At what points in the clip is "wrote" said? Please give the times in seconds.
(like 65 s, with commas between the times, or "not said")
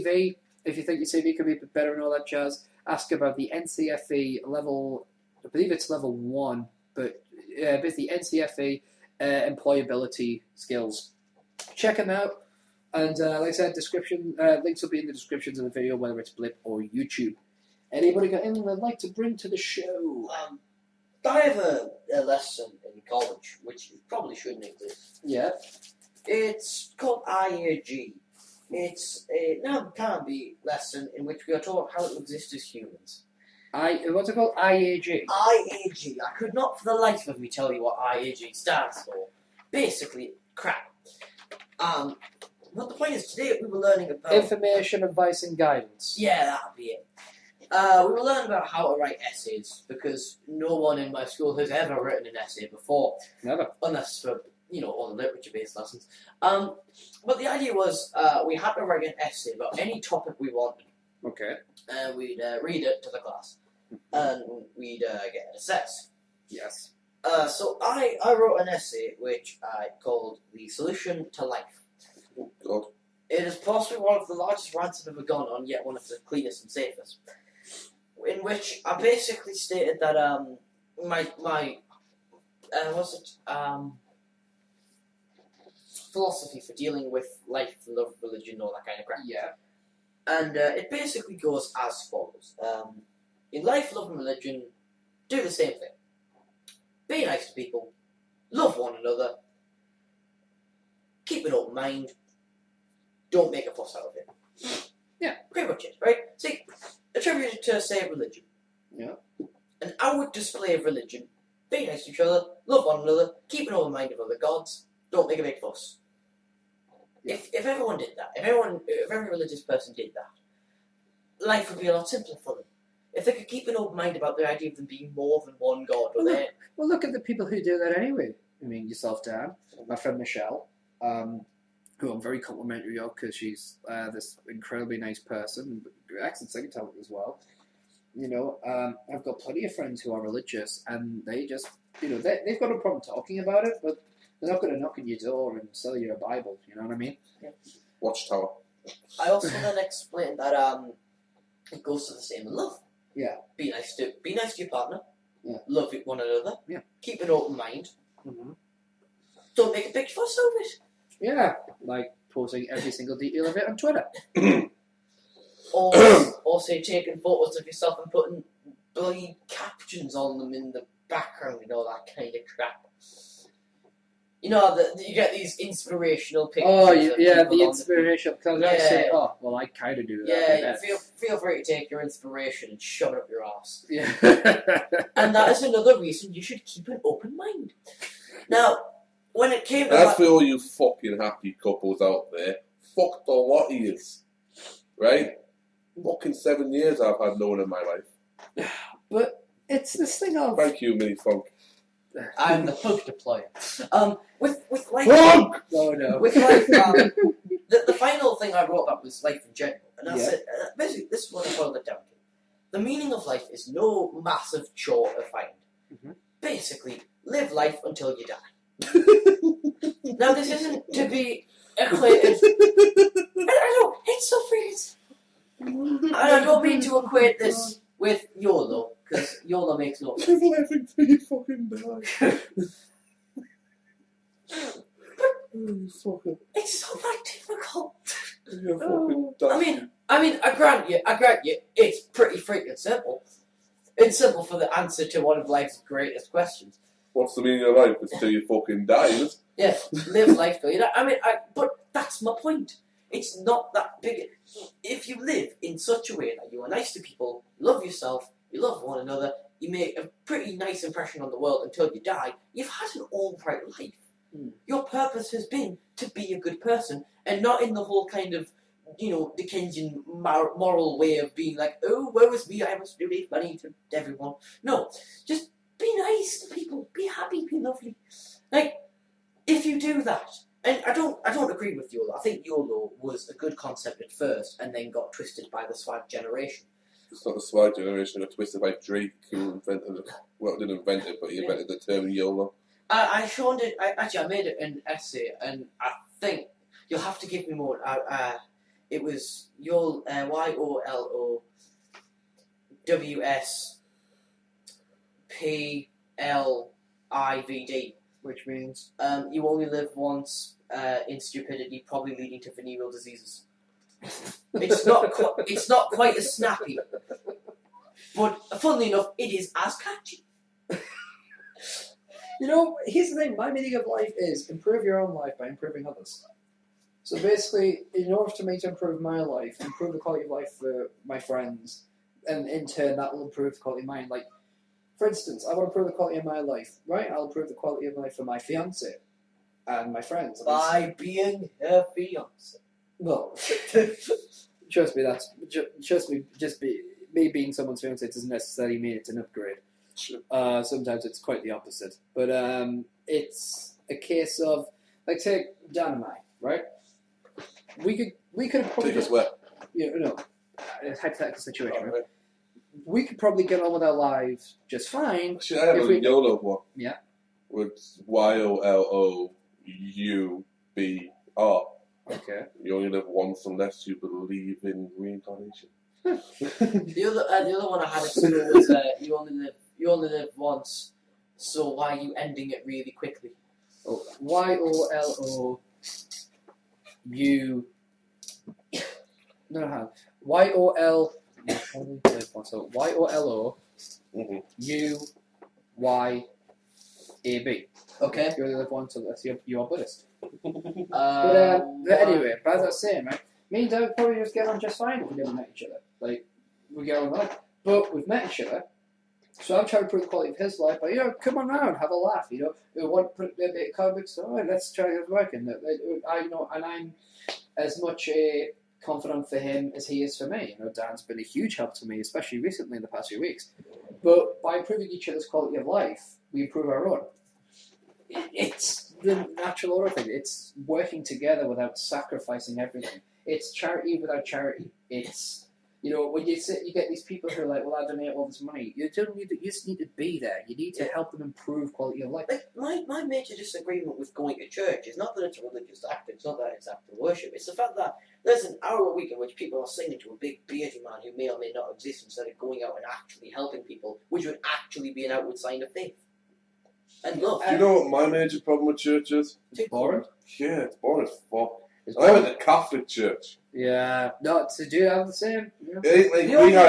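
68 s, 208 s.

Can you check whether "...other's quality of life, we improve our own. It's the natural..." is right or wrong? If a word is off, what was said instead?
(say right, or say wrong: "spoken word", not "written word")
right.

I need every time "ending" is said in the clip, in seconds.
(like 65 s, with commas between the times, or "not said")
382 s.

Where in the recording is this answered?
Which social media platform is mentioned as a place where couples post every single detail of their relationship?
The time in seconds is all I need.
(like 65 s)
163 s.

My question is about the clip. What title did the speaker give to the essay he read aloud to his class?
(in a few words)
The Solution to Life.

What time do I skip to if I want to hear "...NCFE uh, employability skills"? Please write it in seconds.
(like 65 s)
8 s.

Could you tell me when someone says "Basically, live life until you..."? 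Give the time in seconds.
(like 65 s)
216 s.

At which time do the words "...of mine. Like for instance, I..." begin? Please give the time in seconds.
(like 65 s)
333 s.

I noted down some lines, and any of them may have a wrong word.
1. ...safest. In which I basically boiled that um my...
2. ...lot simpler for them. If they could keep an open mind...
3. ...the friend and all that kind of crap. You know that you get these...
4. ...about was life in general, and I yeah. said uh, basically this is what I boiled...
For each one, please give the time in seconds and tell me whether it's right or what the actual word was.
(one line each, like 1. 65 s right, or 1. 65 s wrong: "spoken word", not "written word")
1. 76 s wrong: "stated", not "boiled"
2. 121 s right
3. 170 s wrong: "background", not "friend"
4. 208 s right.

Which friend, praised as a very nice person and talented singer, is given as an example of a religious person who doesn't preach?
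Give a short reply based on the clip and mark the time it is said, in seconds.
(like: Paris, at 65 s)
Michelle, at 130 s.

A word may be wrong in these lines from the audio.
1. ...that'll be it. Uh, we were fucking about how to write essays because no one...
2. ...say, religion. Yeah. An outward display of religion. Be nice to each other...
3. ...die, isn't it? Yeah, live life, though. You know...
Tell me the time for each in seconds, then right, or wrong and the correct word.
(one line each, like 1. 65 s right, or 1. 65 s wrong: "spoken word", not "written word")
1. 46 s wrong: "learning", not "fucking"
2. 107 s right
3. 248 s right.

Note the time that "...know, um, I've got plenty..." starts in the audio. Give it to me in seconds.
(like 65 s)
138 s.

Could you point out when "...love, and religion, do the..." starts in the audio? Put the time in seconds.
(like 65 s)
93 s.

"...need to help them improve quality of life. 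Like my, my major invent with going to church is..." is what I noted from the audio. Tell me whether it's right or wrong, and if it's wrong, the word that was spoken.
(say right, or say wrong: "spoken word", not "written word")
wrong: "disagreement", not "invent".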